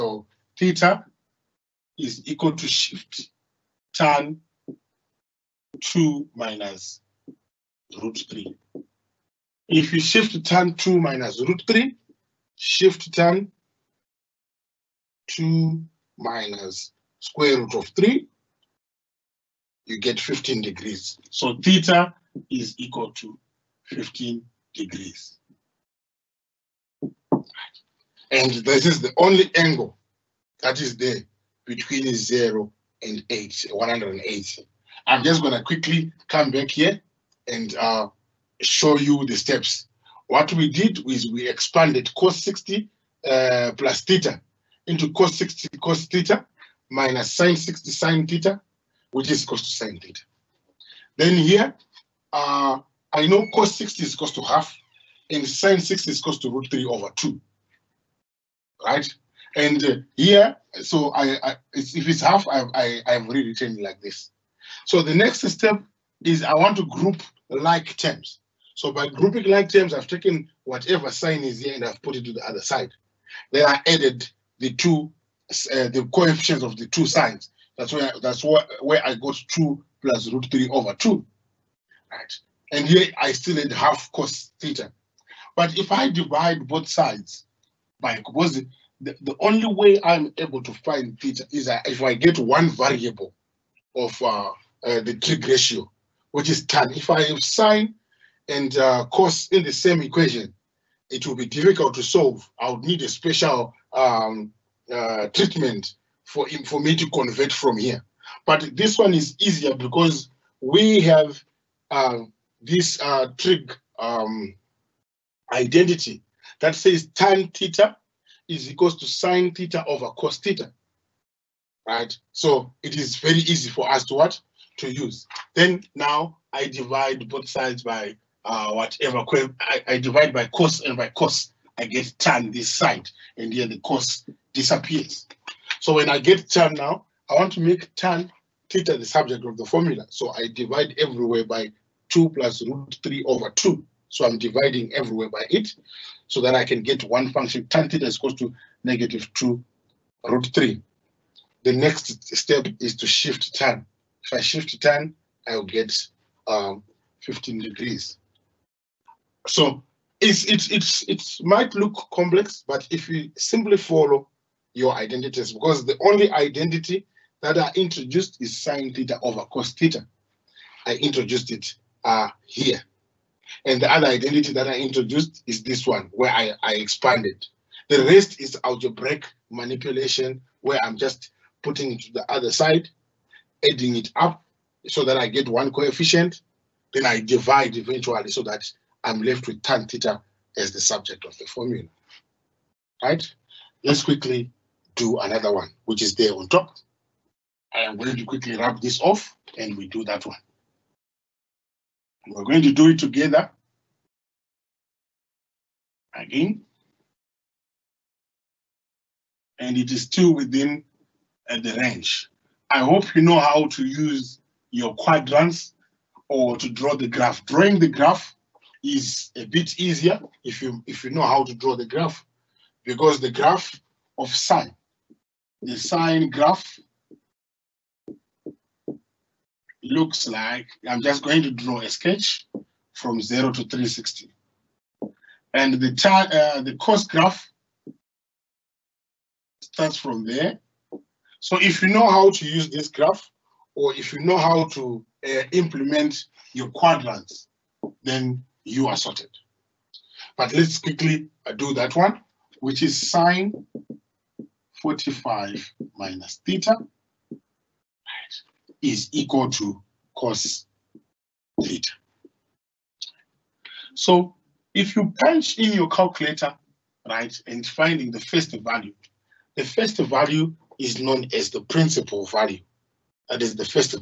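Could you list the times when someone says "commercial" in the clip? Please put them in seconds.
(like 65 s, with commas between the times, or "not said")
not said.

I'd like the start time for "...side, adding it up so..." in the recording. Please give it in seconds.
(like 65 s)
182 s.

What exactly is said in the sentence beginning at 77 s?
That's where that's where, where I got 2 plus root 3 over 2.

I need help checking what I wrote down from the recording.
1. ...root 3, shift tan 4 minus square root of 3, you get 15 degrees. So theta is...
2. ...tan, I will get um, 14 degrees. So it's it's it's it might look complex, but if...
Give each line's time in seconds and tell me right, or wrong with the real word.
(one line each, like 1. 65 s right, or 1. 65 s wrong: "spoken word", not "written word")
1. 11 s wrong: "2", not "4"
2. 154 s wrong: "15", not "14".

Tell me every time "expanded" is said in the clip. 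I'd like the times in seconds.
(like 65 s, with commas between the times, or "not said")
41 s, 176 s.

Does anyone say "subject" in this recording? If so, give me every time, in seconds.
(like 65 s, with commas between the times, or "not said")
139 s, 190 s.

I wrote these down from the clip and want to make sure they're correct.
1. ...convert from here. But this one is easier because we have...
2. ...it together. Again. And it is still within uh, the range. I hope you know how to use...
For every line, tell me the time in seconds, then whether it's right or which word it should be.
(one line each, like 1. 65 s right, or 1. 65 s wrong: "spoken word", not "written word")
1. 107 s right
2. 202 s right.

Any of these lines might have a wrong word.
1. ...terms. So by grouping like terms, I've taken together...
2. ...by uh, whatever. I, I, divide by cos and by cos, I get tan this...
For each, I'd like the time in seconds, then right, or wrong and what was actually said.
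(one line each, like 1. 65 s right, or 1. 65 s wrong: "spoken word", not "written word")
1. 67 s wrong: "whatever", not "together"
2. 127 s right.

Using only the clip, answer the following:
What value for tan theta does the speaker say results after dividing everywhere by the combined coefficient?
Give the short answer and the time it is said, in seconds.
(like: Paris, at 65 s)
negative 2 root 3, at 148 s.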